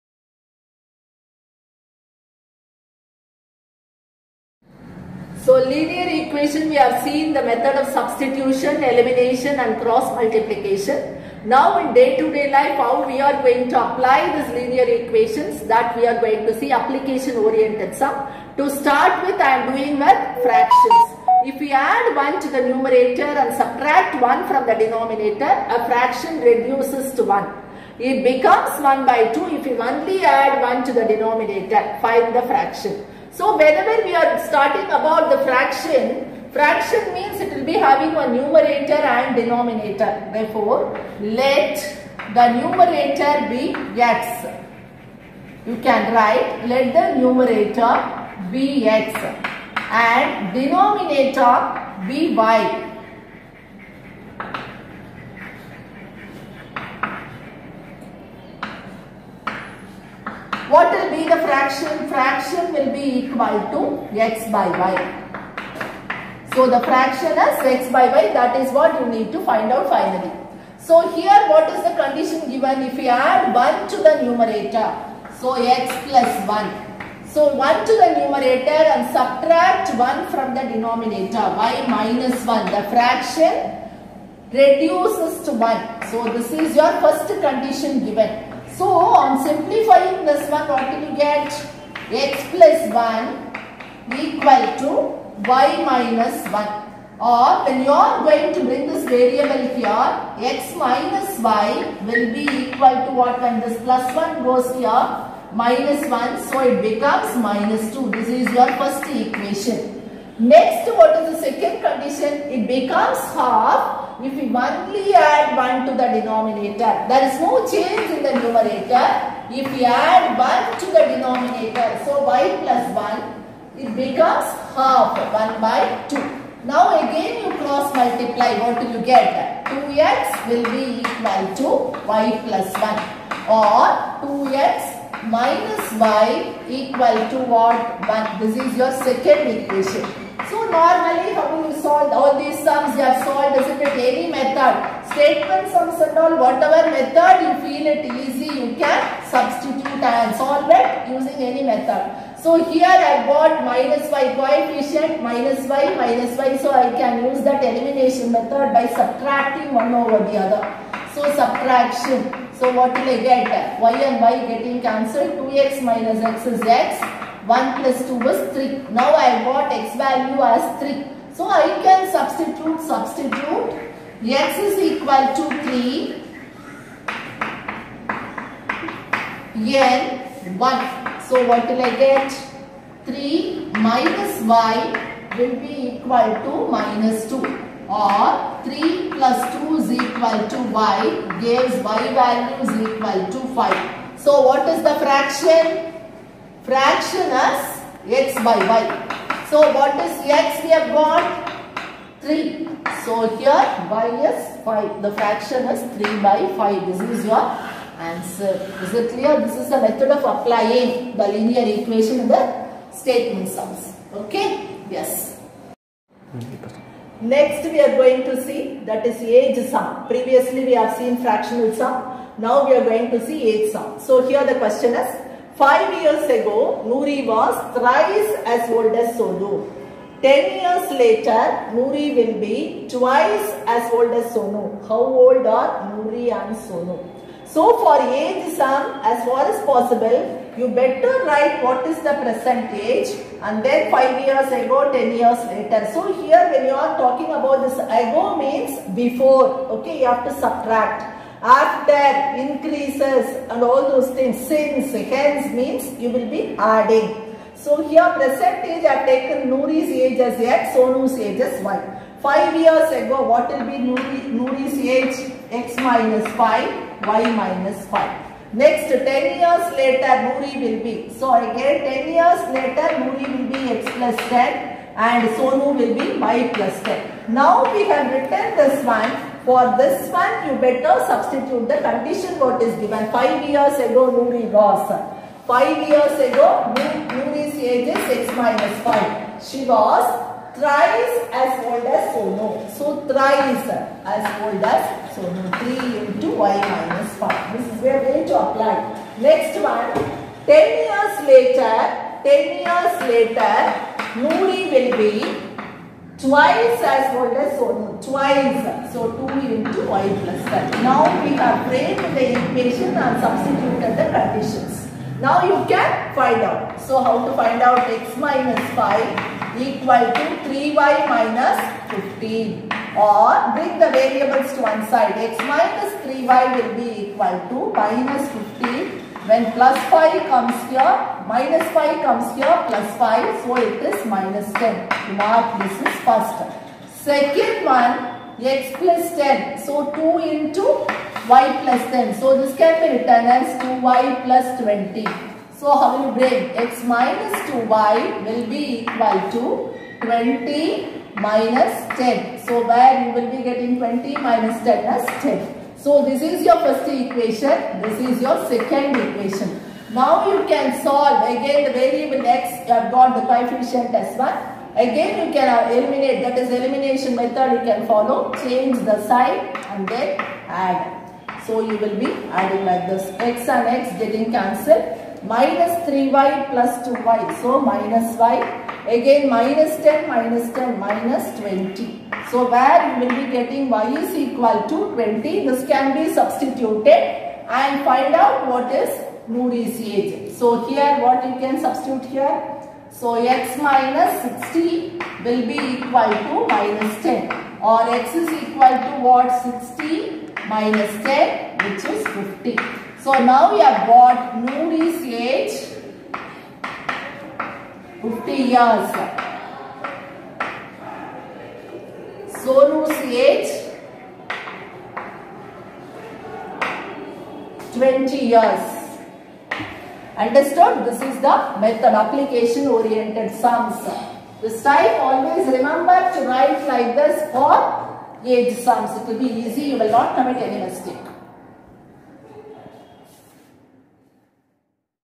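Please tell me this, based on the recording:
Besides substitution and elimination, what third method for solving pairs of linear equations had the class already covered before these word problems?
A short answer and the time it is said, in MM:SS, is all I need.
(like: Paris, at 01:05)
cross multiplication, at 00:09.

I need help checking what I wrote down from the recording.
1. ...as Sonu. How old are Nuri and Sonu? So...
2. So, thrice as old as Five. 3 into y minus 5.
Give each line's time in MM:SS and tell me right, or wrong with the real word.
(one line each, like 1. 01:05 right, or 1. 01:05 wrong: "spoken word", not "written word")
1. 03:54 right
2. 04:52 wrong: "Sonu", not "Five".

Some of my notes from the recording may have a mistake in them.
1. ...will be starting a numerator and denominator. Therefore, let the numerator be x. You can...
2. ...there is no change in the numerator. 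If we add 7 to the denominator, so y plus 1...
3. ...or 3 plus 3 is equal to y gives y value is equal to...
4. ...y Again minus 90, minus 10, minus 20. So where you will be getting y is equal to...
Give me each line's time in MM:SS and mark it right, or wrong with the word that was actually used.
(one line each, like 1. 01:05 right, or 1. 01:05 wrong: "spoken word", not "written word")
1. 00:37 wrong: "having", not "starting"
2. 01:57 wrong: "1", not "7"
3. 03:07 wrong: "2", not "3"
4. 06:18 wrong: "10", not "90".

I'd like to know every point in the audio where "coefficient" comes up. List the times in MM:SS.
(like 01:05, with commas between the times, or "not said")
02:34, 06:03.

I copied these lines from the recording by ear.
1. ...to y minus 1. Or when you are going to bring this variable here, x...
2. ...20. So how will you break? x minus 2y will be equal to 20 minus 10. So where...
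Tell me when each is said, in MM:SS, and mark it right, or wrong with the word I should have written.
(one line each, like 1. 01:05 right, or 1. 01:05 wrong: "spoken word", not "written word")
1. 01:34 right
2. 05:44 right.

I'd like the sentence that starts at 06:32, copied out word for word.
So x minus 60 will be equal to minus 10 or x is equal to what 60 minus 10 which is 50.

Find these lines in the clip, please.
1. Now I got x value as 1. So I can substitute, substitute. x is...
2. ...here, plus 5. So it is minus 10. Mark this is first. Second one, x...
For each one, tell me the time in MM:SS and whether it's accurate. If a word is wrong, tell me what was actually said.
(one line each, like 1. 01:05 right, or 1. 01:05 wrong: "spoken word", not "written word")
1. 02:48 wrong: "3", not "1"
2. 05:32 right.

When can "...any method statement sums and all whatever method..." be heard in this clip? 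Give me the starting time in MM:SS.
02:24.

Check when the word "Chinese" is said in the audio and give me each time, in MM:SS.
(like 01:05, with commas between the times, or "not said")
not said.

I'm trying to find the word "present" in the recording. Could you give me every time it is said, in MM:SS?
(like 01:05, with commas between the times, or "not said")
04:02, 04:18.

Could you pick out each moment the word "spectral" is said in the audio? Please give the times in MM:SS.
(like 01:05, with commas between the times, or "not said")
not said.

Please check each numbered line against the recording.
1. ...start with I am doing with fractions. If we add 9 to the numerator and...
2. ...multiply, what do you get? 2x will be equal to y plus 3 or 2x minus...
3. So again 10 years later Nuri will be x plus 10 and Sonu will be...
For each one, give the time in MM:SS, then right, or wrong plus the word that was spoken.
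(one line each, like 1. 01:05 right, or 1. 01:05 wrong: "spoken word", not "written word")
1. 00:18 wrong: "1", not "9"
2. 02:07 wrong: "1", not "3"
3. 04:31 right.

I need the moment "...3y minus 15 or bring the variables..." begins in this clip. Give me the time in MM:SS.
05:20.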